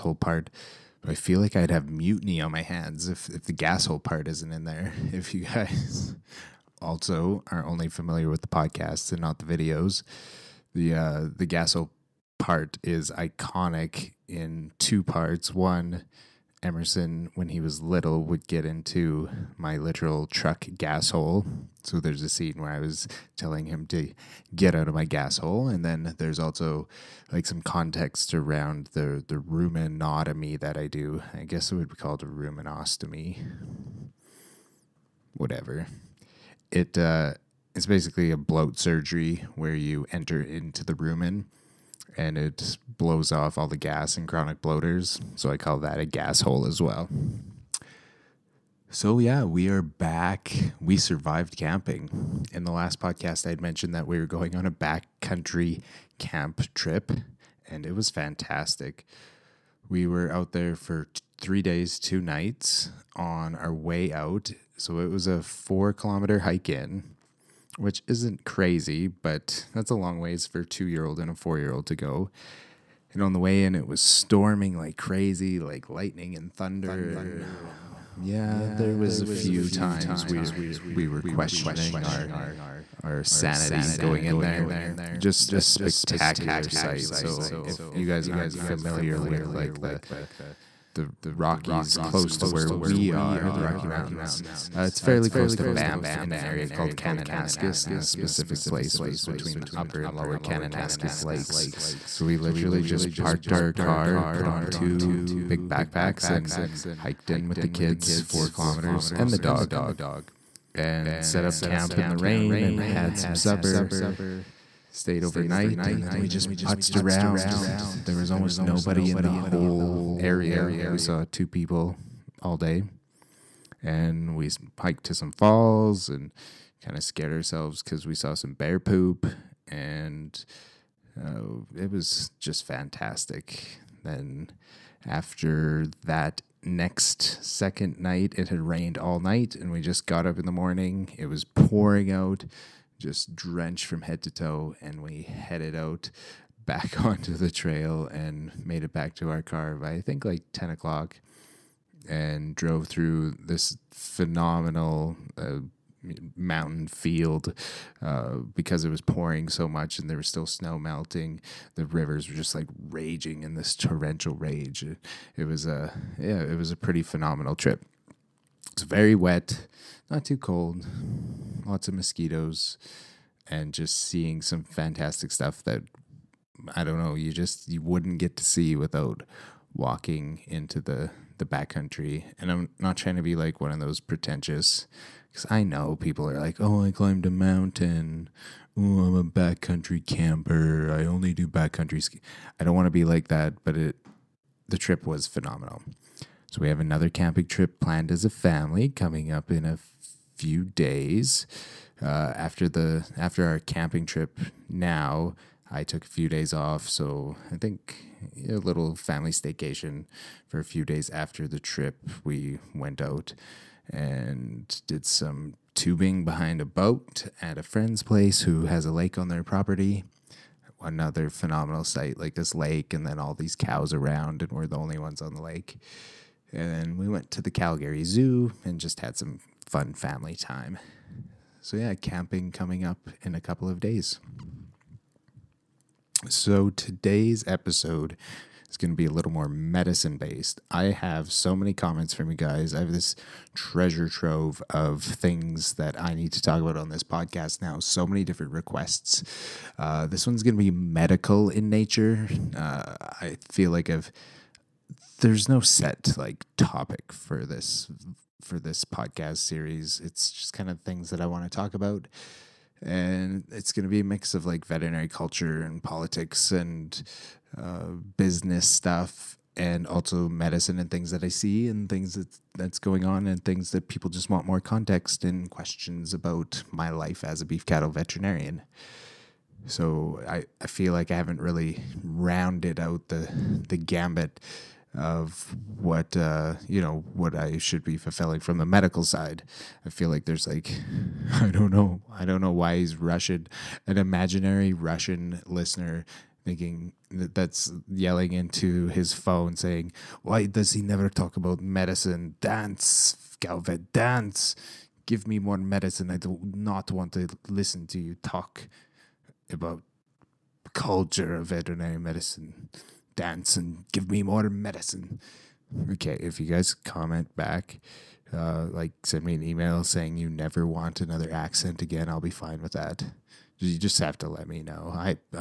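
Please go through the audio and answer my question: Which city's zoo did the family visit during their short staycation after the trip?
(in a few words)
Calgary.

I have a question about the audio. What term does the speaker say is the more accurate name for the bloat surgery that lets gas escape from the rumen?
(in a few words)
rumenostomy.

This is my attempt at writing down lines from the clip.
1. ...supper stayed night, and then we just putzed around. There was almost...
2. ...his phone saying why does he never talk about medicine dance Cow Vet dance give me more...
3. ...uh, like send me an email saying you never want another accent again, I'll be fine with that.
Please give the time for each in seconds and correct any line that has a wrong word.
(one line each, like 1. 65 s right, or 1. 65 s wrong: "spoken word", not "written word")
1. 113 s wrong: "overnight", not "night"
2. 298 s right
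3. 318 s right.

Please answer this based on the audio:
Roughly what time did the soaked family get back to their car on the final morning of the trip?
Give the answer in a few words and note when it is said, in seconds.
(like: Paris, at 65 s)
10 o'clock, at 150 s.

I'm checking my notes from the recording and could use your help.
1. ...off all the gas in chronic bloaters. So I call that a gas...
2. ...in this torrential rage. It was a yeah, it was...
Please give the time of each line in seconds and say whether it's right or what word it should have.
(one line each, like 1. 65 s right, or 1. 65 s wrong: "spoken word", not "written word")
1. 43 s right
2. 163 s right.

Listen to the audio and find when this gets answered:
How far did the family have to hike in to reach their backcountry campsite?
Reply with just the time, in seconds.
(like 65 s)
65 s.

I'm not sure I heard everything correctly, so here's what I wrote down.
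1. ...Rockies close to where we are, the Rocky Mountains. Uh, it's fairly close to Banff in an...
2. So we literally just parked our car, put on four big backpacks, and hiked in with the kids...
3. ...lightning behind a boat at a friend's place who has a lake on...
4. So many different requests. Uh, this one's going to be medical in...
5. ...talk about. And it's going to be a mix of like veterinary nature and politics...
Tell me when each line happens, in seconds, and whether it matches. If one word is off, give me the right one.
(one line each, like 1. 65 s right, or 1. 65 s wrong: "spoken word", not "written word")
1. 91 s right
2. 102 s wrong: "two", not "four"
3. 215 s wrong: "tubing", not "lightning"
4. 247 s right
5. 261 s wrong: "culture", not "nature".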